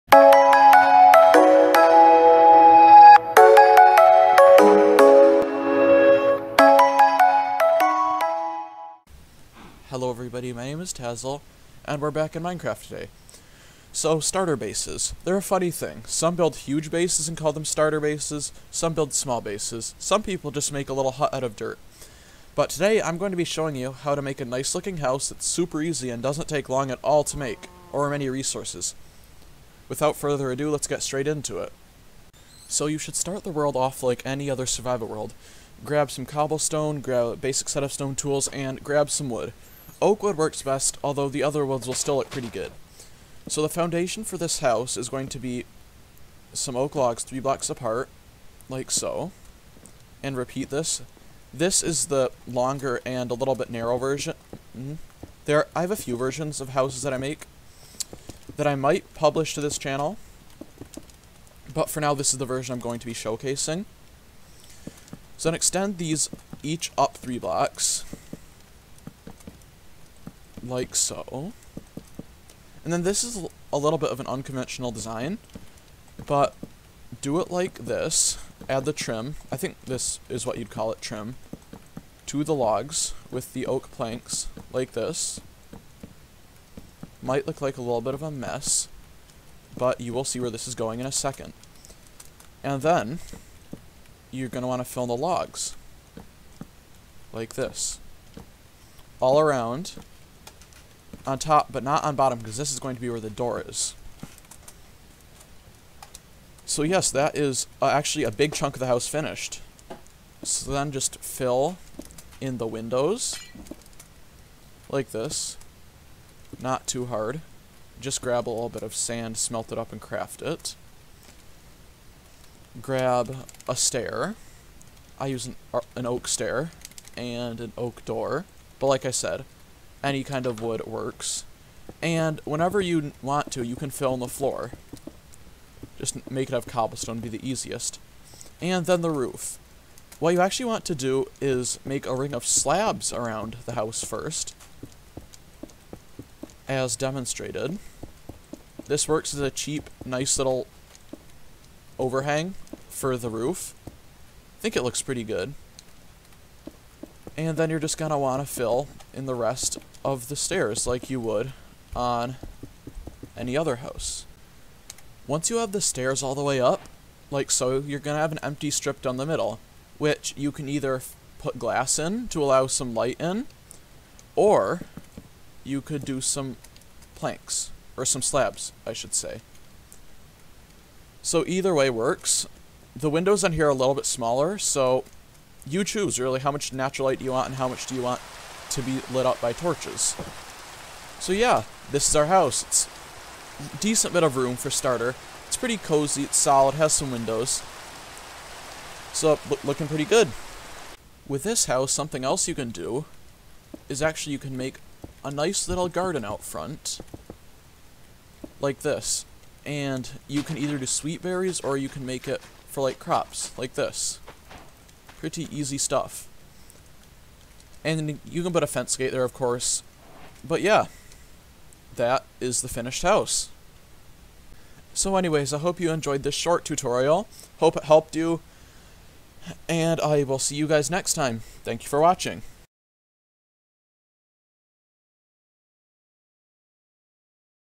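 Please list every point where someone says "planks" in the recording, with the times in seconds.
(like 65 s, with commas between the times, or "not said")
83 s, 177 s.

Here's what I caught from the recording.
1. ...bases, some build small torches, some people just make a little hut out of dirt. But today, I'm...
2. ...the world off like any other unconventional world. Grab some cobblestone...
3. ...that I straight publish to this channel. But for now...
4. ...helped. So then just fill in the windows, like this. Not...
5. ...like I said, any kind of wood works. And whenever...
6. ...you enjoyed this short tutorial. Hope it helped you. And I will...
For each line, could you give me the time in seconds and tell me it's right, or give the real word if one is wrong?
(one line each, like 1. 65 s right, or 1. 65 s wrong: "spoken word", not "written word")
1. 17 s wrong: "bases", not "torches"
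2. 33 s wrong: "survival", not "unconventional"
3. 58 s wrong: "might", not "straight"
4. 109 s wrong: "finished", not "helped"
5. 128 s right
6. 225 s right.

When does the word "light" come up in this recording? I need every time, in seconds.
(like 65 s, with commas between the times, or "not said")
172 s, 187 s.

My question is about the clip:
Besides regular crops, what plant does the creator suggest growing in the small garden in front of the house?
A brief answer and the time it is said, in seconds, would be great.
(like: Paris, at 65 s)
Sweet berries, at 210 s.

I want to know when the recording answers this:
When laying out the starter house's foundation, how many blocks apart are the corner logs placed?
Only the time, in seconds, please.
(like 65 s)
47 s.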